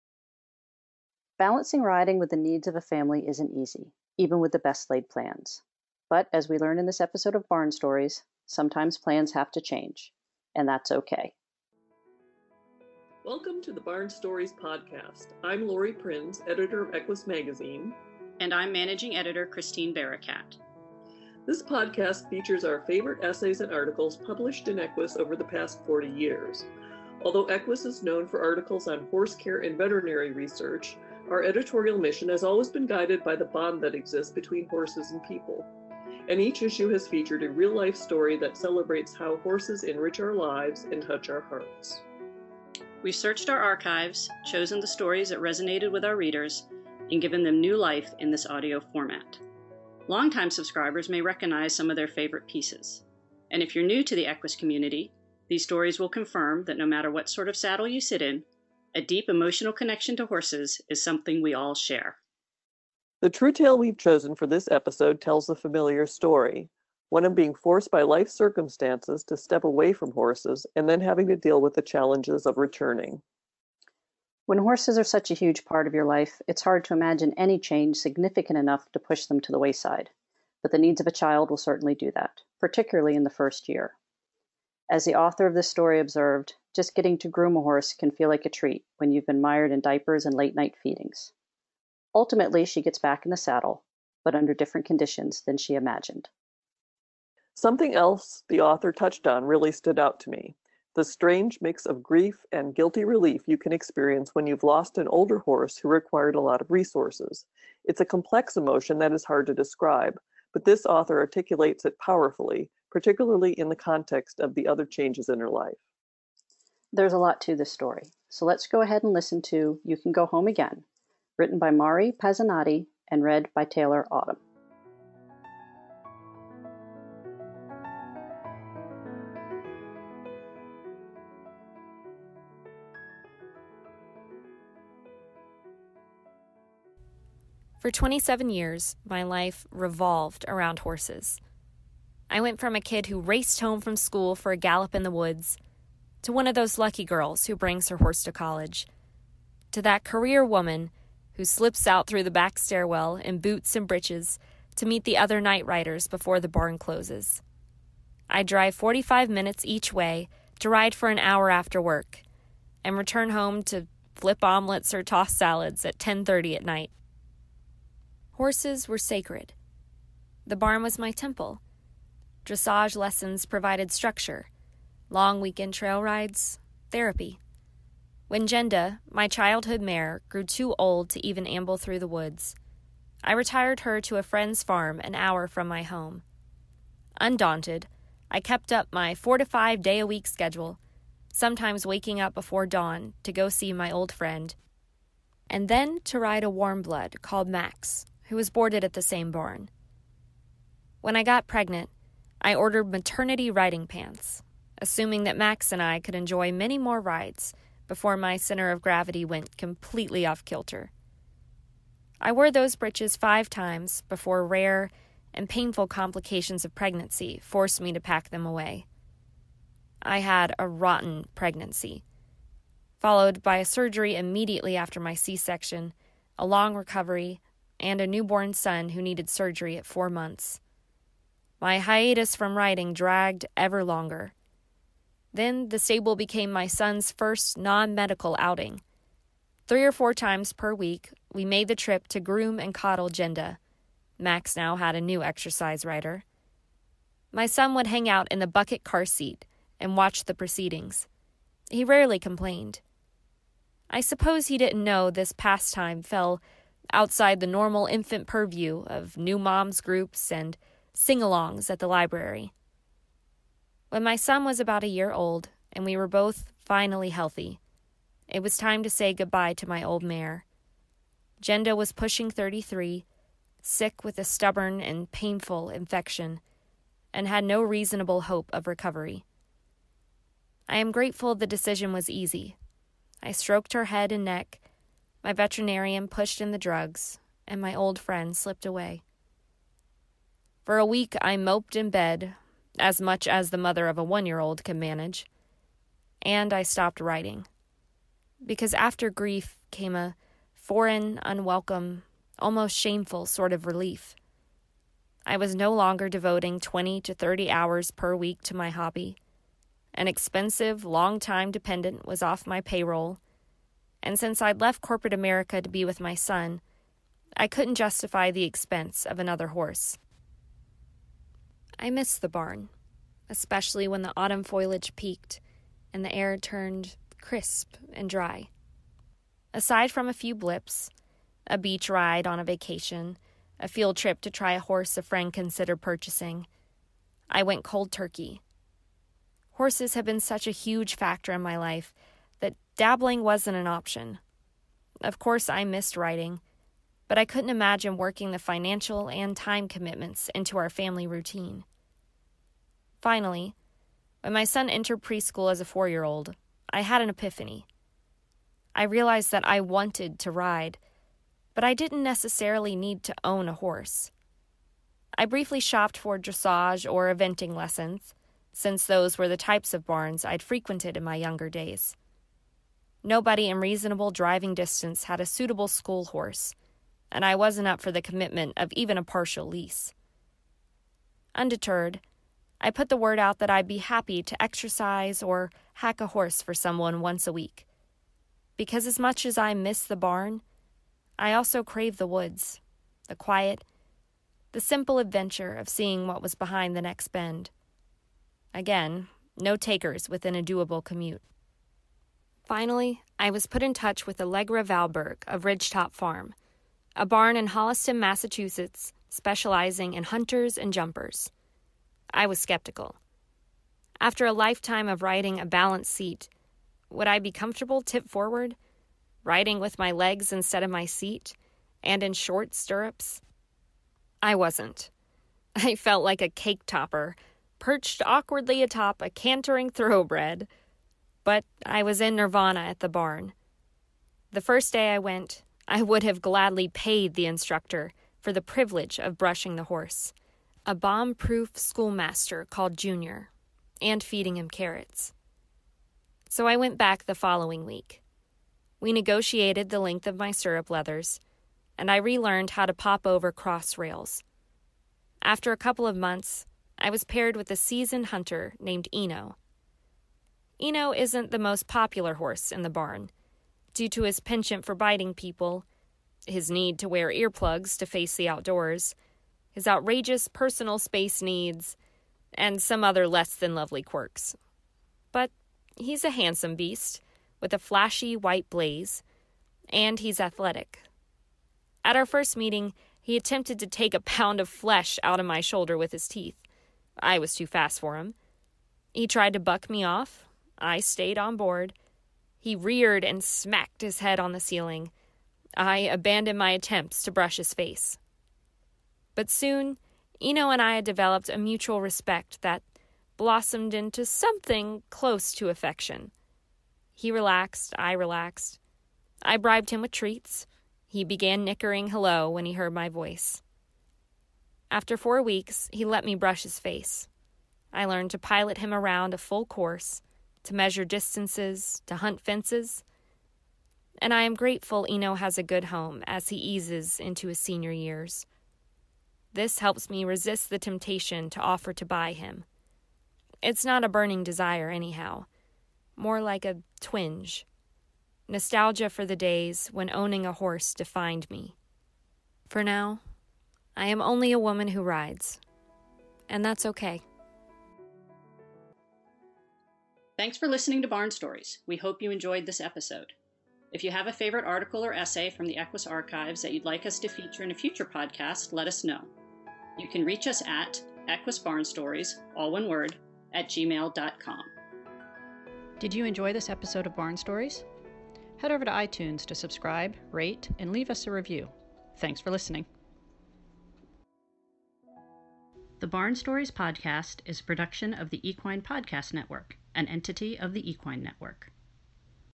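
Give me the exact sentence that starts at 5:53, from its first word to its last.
Finally, when my son entered preschool as a four year old, I had an epiphany.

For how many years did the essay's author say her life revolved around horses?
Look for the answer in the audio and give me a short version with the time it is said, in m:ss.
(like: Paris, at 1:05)
27, at 2:17.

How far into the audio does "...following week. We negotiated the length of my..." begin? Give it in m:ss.
7:27.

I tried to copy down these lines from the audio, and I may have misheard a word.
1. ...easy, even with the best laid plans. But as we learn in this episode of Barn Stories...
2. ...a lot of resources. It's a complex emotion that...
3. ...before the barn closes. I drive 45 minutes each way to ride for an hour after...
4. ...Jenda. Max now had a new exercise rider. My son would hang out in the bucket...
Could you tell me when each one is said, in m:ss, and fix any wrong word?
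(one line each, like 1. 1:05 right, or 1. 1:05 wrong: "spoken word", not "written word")
1. 0:03 right
2. 1:46 right
3. 2:36 right
4. 4:03 right.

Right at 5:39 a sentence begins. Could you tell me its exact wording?
Horses have been such a huge factor in my life that dabbling wasn't an option.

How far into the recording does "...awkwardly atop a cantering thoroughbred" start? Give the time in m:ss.
7:08.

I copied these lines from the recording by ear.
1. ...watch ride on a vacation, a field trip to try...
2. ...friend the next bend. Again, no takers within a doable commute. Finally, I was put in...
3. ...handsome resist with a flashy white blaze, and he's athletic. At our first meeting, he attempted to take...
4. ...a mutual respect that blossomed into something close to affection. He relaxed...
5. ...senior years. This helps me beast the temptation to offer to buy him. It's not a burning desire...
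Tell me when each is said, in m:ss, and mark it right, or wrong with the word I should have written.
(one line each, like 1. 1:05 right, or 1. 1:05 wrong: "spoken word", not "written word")
1. 5:31 wrong: "beach", not "watch"
2. 6:36 wrong: "behind", not "friend"
3. 7:56 wrong: "beast", not "resist"
4. 8:21 right
5. 8:47 wrong: "resist", not "beast".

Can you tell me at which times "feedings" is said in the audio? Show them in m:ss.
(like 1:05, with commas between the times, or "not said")
1:30, 7:24.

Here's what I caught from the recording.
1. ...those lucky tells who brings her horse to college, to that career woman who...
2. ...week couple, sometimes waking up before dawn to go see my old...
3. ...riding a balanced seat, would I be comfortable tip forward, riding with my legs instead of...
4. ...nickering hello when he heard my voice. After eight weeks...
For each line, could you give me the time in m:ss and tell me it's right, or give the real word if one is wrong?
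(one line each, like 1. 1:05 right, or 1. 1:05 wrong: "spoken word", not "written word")
1. 2:26 wrong: "girls", not "tells"
2. 3:10 wrong: "schedule", not "couple"
3. 6:55 right
4. 8:31 wrong: "four", not "eight".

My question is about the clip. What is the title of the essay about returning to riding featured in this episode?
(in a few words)
You Can Go Home Again.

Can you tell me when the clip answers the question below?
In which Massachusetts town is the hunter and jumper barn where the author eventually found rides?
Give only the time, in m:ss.
6:47.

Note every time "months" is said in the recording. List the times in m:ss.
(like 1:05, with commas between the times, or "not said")
3:50, 7:35.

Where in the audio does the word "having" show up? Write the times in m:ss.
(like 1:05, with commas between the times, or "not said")
1:10.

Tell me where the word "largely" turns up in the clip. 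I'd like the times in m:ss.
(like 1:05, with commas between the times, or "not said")
not said.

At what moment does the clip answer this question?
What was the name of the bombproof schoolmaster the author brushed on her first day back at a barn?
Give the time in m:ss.
7:22.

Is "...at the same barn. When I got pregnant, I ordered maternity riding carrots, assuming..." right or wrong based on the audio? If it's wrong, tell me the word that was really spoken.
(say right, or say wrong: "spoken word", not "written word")
wrong: "pants", not "carrots".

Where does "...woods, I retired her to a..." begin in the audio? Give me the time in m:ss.
3:02.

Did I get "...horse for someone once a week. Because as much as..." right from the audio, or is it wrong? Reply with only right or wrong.
right.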